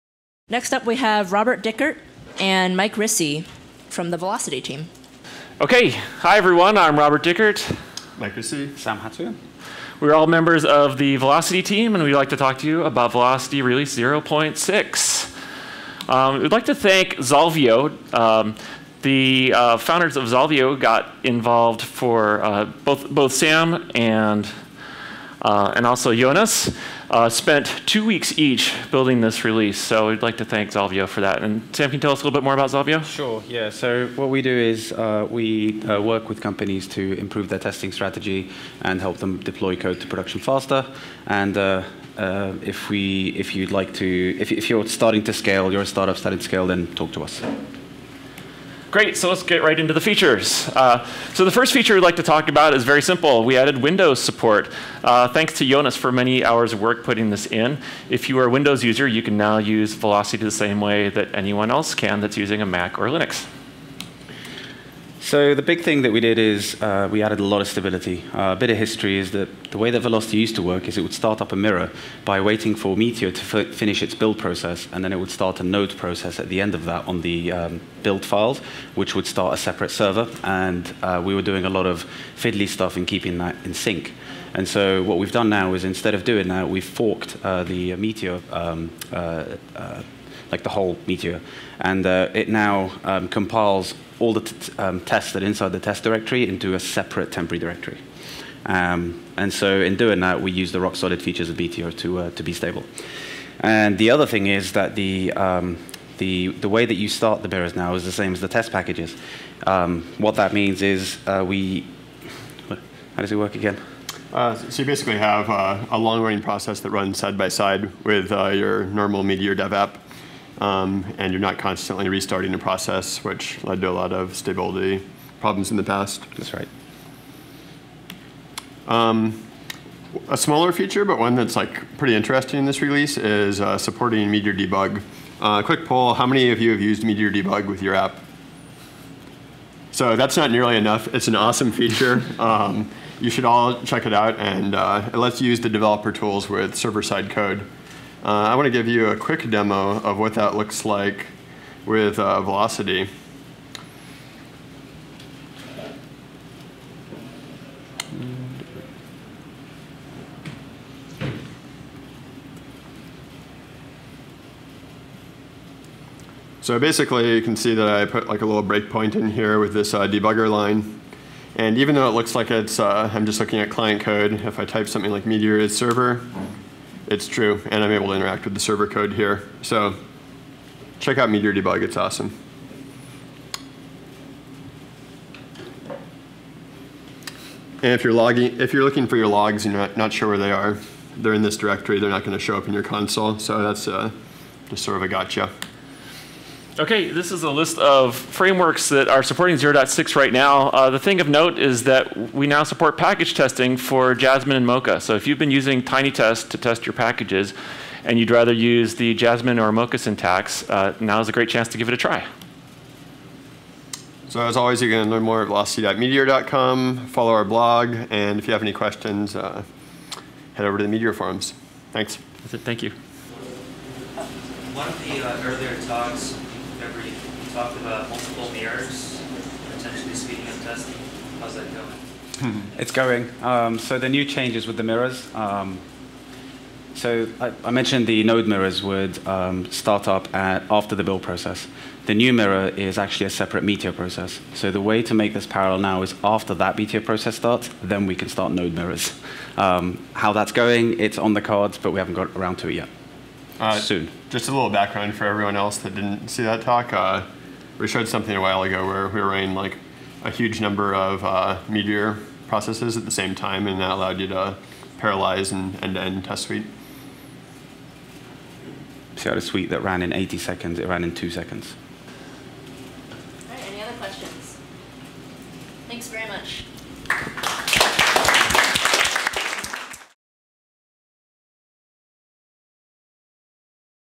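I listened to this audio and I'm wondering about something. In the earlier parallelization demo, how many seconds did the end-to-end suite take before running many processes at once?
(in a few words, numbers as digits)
80 seconds.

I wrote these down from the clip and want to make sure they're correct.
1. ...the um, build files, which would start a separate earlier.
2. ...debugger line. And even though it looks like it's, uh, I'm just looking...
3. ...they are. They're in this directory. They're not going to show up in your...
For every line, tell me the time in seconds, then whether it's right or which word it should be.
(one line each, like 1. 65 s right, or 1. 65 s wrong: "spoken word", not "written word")
1. 77 s wrong: "server", not "earlier"
2. 170 s right
3. 190 s right.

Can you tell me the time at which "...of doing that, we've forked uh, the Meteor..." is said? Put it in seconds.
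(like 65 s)
86 s.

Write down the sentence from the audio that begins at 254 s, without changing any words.
Just a little background for everyone else that didn't see that talk.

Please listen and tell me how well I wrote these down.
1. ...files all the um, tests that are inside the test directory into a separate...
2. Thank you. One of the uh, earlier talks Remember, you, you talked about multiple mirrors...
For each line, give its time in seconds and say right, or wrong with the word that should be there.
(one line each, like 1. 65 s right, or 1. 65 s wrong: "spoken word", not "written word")
1. 93 s wrong: "compiles", not "files"
2. 222 s right.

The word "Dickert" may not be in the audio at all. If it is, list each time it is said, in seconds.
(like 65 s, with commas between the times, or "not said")
1 s, 7 s.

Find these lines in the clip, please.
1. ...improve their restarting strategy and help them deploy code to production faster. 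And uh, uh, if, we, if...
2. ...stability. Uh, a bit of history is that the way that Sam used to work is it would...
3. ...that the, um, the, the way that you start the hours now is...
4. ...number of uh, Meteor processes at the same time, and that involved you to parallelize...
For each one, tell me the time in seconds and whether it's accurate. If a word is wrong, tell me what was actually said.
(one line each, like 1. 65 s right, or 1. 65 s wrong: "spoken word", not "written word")
1. 37 s wrong: "testing", not "restarting"
2. 67 s wrong: "Velocity", not "Sam"
3. 104 s wrong: "mirrors", not "hours"
4. 260 s wrong: "allowed", not "involved".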